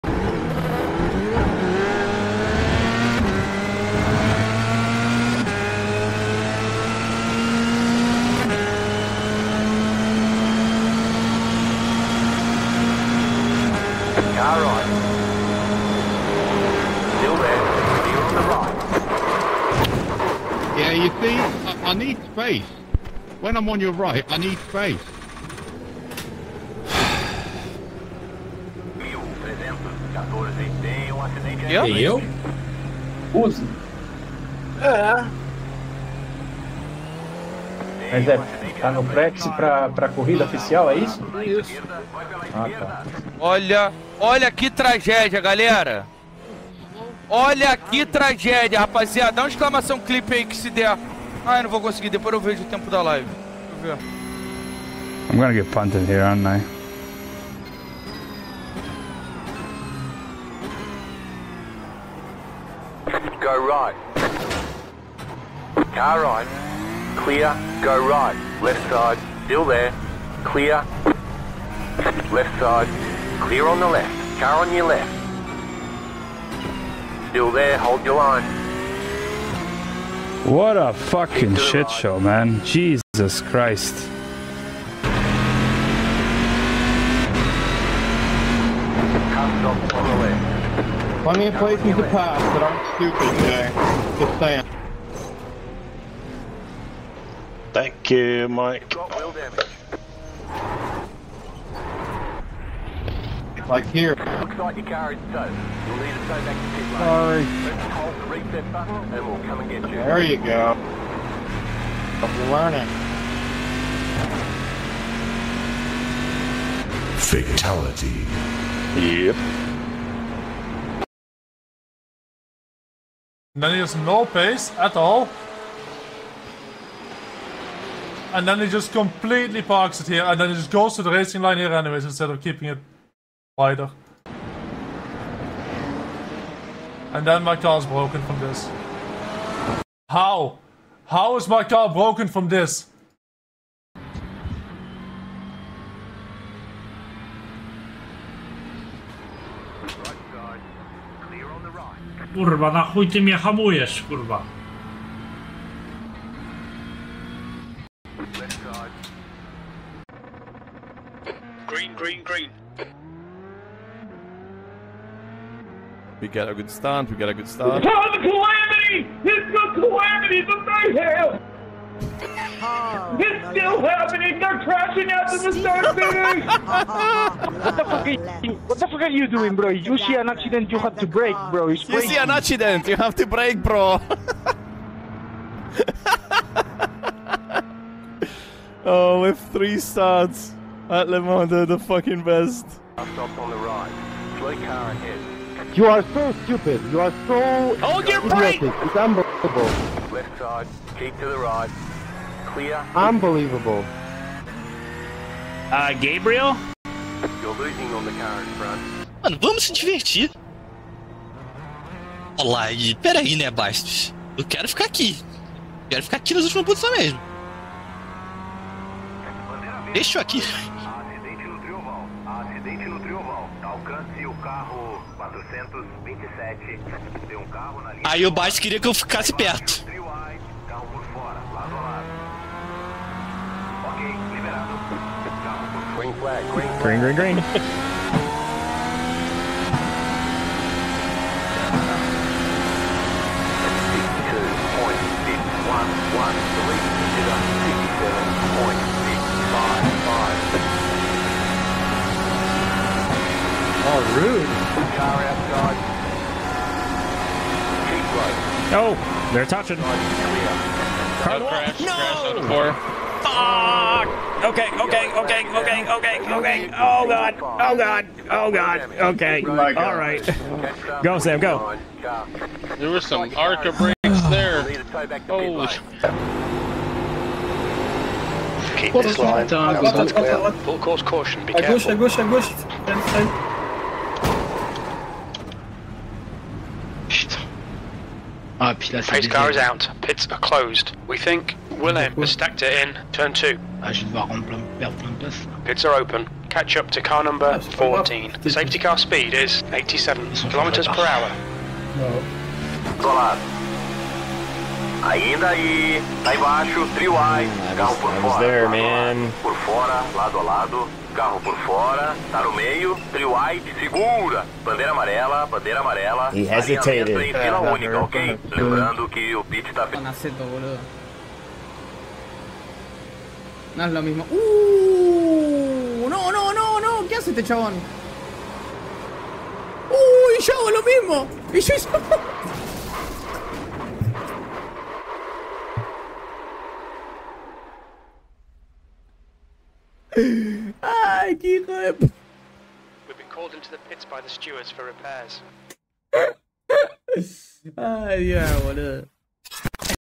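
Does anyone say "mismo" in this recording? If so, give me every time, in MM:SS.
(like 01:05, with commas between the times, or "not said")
05:24, 05:30.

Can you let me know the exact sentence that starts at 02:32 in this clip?
Kurwa, na chuj ty mnie hamujesz, kurwa.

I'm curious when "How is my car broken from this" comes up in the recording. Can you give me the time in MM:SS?
02:21.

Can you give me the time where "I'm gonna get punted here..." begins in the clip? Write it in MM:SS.
00:55.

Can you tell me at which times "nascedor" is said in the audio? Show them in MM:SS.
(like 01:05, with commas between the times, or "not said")
05:19.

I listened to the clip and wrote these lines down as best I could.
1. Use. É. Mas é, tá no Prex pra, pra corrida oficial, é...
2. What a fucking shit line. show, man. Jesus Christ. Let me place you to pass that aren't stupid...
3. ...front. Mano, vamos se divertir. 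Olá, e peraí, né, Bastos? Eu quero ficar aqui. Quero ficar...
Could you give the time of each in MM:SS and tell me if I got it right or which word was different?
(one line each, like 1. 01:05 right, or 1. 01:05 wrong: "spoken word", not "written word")
1. 00:33 right
2. 01:20 right
3. 03:28 right.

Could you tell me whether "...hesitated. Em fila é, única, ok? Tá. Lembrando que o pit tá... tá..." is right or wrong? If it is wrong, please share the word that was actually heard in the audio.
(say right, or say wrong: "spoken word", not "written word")
right.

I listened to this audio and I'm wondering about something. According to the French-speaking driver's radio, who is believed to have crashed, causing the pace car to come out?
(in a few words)
Willem.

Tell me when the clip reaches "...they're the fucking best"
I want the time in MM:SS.
03:11.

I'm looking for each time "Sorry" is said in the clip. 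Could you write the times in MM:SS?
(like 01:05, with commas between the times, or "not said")
01:46.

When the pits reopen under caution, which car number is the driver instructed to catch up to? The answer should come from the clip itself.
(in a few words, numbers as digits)
14.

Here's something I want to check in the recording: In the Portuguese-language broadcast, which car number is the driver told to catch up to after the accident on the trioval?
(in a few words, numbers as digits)
427.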